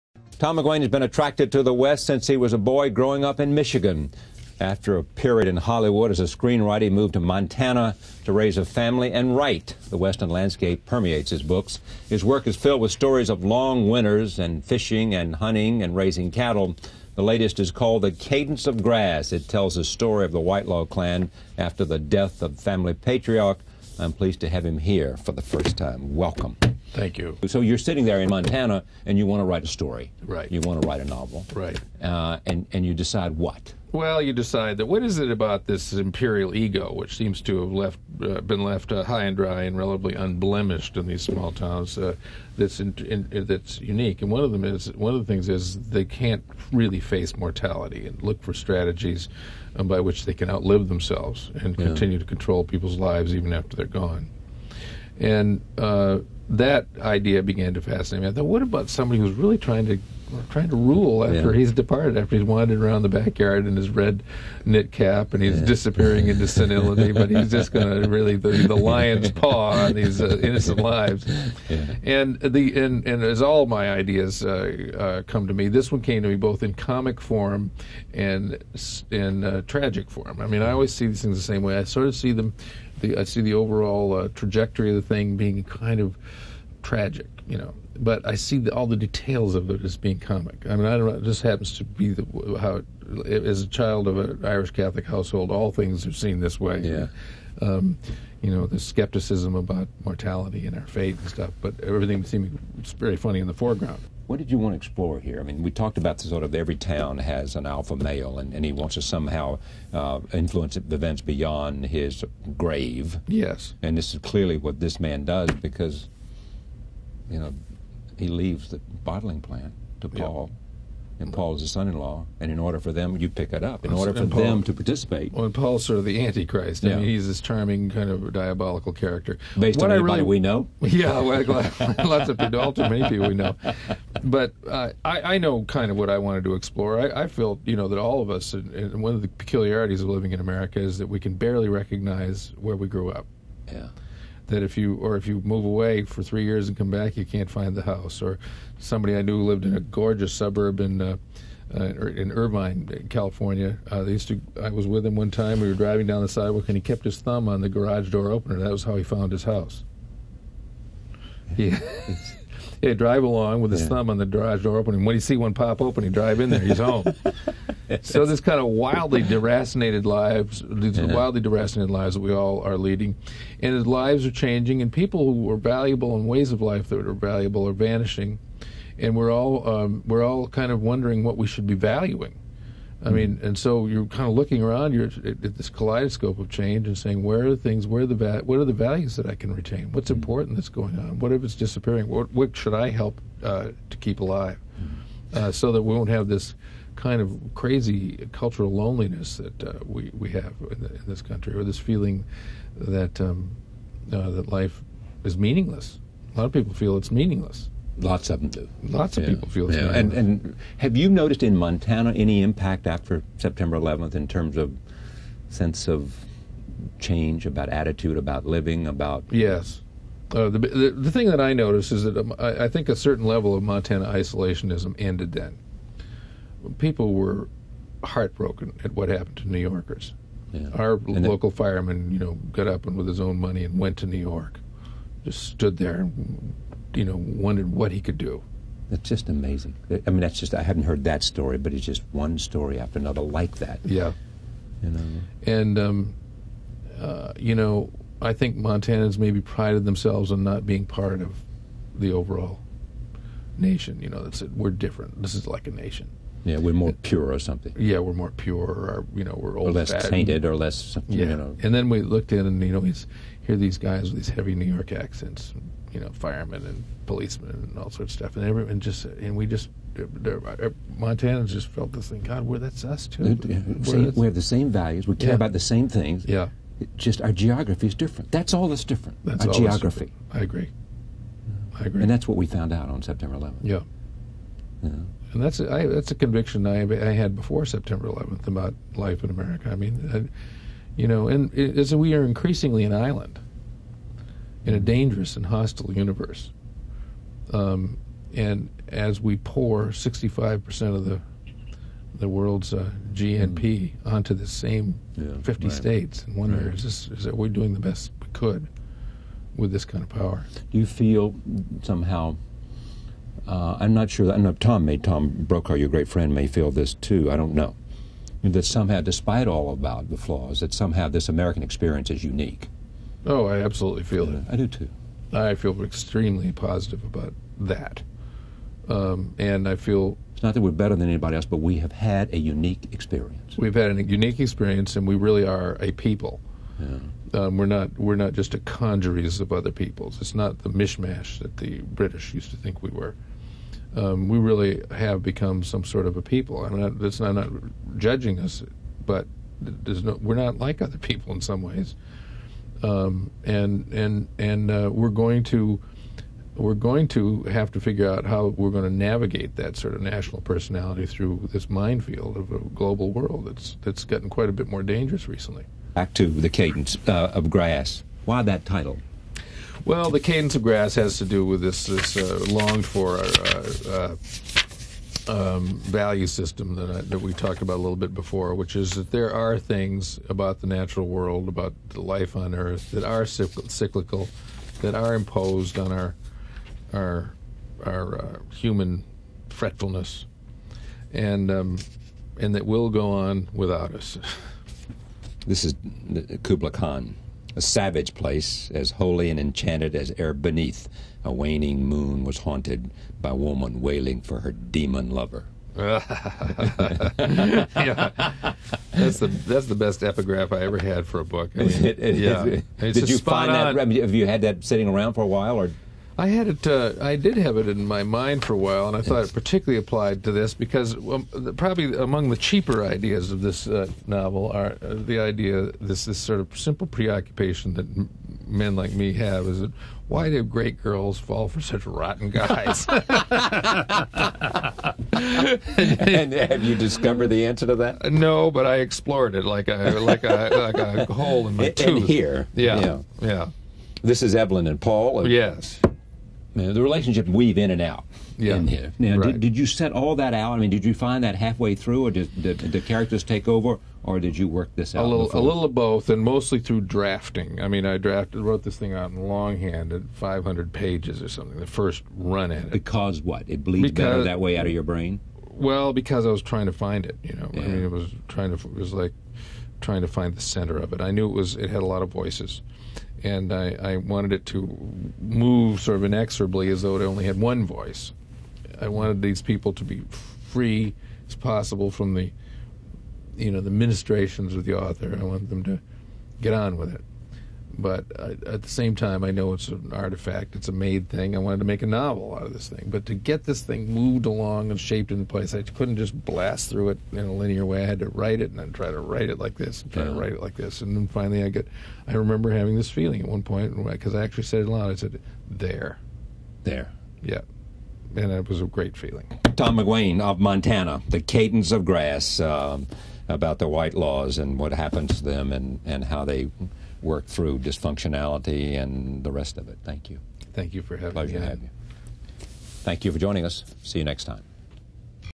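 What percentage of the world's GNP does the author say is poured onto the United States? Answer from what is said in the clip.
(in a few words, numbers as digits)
65%.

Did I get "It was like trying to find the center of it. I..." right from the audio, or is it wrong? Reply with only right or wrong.
right.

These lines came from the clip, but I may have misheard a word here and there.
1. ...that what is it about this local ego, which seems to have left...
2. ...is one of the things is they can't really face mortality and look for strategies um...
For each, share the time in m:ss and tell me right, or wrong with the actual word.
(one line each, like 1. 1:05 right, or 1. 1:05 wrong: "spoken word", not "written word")
1. 0:34 wrong: "imperial", not "local"
2. 0:44 right.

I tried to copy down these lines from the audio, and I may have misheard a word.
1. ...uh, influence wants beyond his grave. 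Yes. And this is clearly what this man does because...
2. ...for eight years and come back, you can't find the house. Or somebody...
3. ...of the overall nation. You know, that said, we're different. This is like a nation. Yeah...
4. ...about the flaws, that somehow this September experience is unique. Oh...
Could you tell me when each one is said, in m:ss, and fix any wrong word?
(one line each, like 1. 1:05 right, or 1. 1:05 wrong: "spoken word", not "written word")
1. 1:49 wrong: "events", not "wants"
2. 2:26 wrong: "three", not "eight"
3. 4:11 right
4. 5:19 wrong: "American", not "September".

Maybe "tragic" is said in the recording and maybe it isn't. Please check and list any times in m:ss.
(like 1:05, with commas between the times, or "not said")
1:19, 1:26.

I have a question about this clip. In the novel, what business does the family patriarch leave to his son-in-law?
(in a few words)
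bottling plant.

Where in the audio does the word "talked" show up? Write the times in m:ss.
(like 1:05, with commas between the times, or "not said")
1:45, 6:17.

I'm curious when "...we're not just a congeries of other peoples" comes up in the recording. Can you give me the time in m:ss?
5:37.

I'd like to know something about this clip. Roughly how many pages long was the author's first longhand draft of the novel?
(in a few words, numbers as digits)
500.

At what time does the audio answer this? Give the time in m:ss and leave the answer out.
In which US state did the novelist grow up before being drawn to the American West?
0:03.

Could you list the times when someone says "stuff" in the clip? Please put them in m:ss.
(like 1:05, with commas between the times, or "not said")
1:41, 4:28.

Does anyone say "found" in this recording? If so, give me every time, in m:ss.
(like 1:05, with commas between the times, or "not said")
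2:39, 4:42.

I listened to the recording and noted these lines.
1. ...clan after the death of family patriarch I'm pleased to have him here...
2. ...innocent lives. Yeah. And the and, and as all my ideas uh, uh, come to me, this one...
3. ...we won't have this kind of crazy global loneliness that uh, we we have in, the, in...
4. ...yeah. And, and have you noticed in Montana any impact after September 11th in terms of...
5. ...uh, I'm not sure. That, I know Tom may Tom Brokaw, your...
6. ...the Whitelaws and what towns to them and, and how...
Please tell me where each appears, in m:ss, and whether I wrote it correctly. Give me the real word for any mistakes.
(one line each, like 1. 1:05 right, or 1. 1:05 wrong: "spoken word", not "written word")
1. 0:20 right
2. 1:10 right
3. 3:15 wrong: "cultural", not "global"
4. 3:29 right
5. 5:13 right
6. 8:33 wrong: "happens", not "towns".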